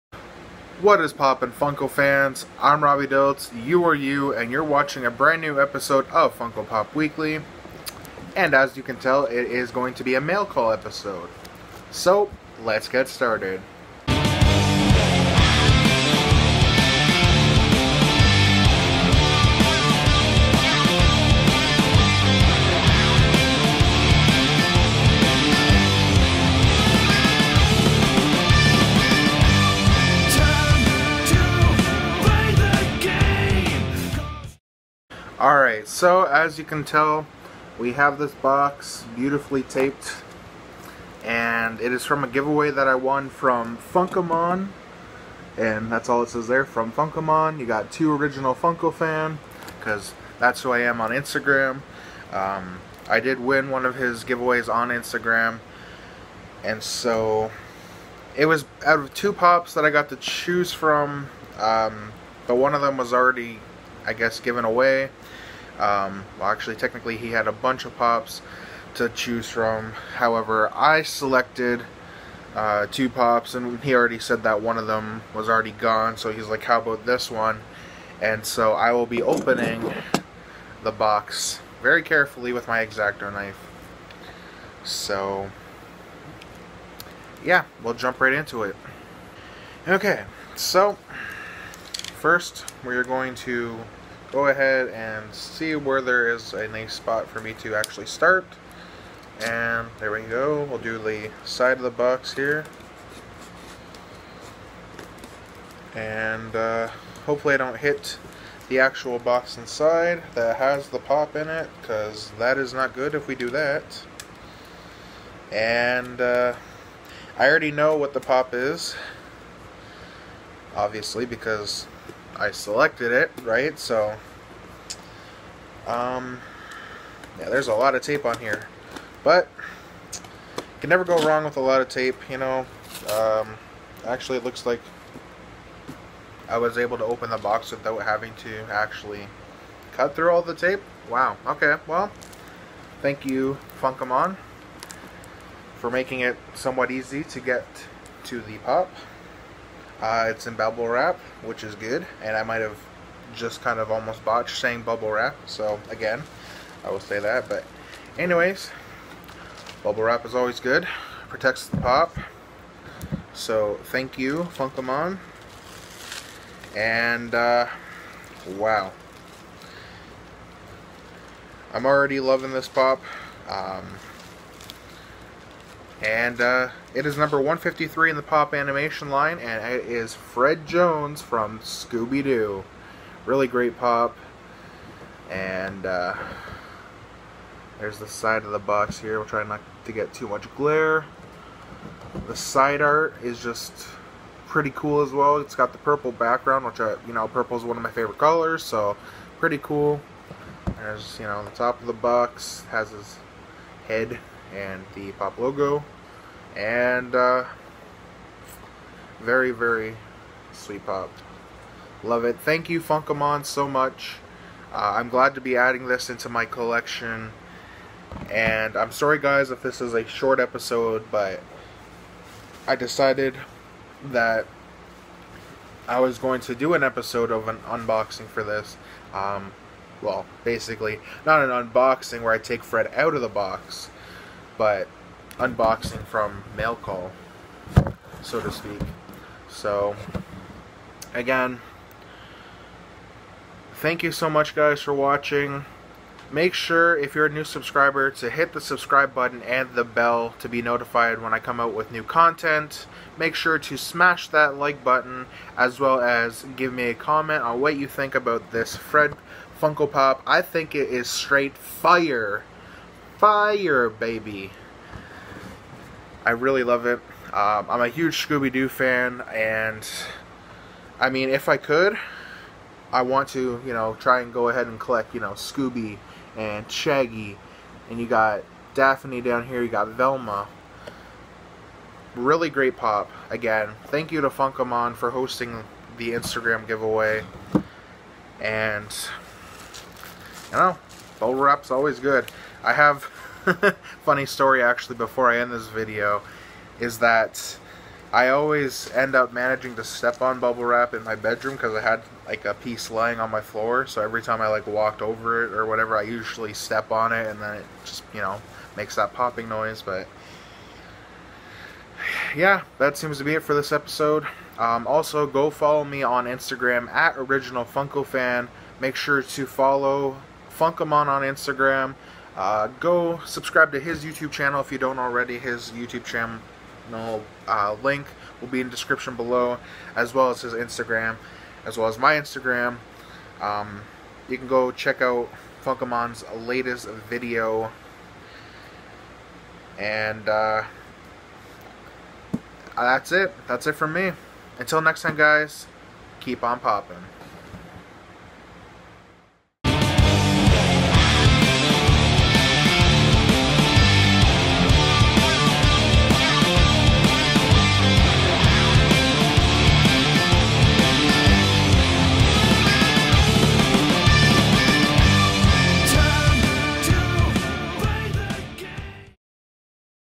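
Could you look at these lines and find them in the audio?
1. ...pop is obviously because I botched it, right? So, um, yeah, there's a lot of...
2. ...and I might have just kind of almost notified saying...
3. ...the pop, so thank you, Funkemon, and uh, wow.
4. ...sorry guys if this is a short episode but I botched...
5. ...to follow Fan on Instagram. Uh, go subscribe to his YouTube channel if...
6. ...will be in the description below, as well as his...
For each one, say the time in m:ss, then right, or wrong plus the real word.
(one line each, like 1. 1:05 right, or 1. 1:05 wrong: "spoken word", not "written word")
1. 1:58 wrong: "selected", not "botched"
2. 2:32 wrong: "botched", not "notified"
3. 2:41 right
4. 3:38 wrong: "decided", not "botched"
5. 5:19 wrong: "Funkemon", not "Fan"
6. 5:28 right.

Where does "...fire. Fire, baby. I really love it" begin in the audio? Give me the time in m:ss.
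4:21.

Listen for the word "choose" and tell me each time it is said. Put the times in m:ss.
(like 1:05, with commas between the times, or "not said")
1:00, 1:09.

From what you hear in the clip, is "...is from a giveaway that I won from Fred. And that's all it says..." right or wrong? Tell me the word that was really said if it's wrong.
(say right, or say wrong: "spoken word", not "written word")
wrong: "Funkemon", not "Fred".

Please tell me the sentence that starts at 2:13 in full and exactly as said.
Um, actually, it looks like I was able to open the box without having to actually cut through all the tape.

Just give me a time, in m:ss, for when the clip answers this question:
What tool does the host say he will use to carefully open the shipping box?
1:22.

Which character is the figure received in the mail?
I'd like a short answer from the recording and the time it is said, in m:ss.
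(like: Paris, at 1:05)
Fred Jones, at 3:00.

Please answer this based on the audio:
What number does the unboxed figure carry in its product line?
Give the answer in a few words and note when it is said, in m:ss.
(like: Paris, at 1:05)
153, at 2:57.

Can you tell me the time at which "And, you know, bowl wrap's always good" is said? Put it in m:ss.
4:48.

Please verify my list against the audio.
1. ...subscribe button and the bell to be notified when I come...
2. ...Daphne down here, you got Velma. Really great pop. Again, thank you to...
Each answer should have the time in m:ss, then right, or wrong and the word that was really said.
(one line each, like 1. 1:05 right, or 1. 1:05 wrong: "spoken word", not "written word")
1. 4:08 right
2. 4:38 right.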